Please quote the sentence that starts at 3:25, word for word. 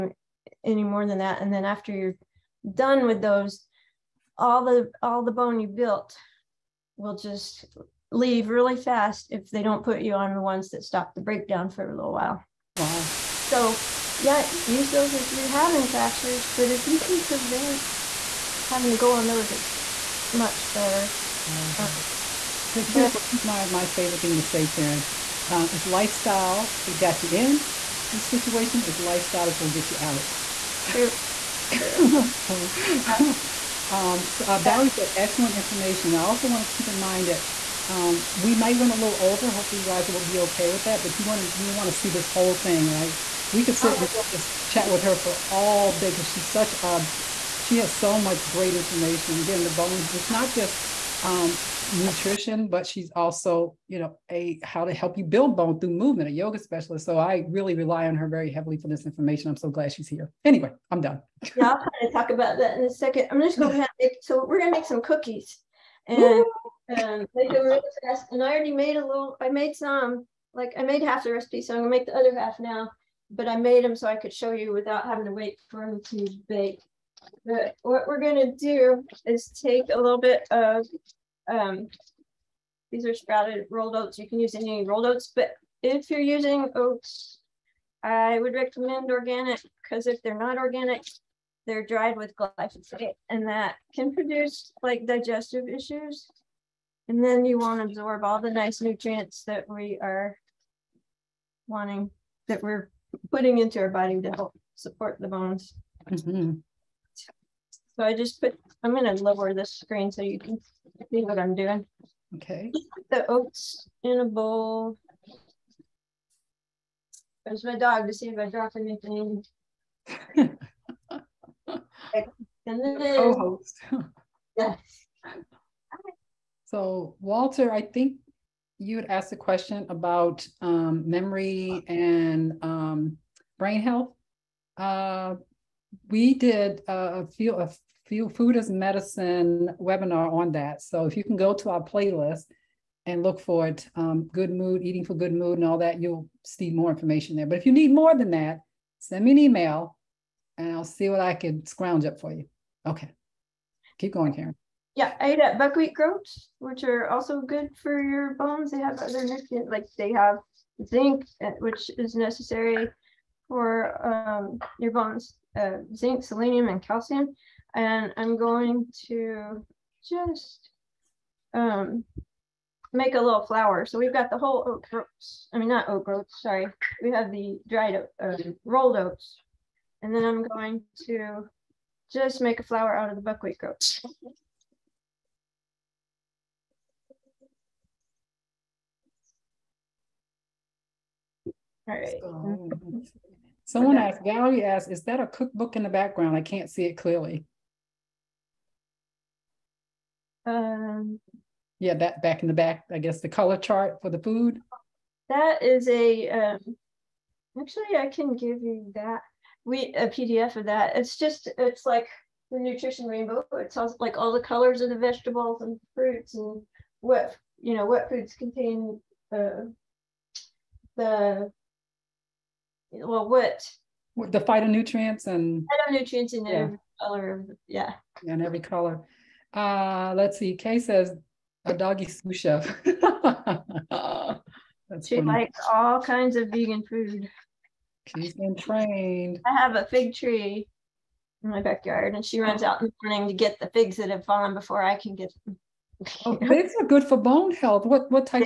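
That is a, um, actually I can give you that, we a PDF of that.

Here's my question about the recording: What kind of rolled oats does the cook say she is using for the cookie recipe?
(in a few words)
Sprouted rolled oats.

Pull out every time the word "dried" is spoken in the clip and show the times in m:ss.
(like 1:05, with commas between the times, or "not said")
1:31, 2:57.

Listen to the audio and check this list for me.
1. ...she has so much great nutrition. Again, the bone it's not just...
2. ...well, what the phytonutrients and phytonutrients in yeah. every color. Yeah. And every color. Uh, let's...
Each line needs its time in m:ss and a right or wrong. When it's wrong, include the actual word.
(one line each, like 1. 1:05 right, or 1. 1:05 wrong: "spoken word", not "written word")
1. 0:47 wrong: "information", not "nutrition"
2. 3:42 right.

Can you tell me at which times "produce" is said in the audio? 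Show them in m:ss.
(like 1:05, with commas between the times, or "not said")
1:34.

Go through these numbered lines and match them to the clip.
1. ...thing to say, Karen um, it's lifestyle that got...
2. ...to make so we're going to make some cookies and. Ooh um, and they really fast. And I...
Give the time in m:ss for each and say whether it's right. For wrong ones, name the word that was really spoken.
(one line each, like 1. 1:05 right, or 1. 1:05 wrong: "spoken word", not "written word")
1. 0:24 right
2. 1:03 right.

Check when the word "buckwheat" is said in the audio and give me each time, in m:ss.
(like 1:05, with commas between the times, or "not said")
2:35, 3:03.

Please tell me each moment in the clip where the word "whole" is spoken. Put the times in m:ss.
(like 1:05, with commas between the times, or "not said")
0:42, 2:54.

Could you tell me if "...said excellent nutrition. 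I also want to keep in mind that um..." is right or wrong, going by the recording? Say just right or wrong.
wrong.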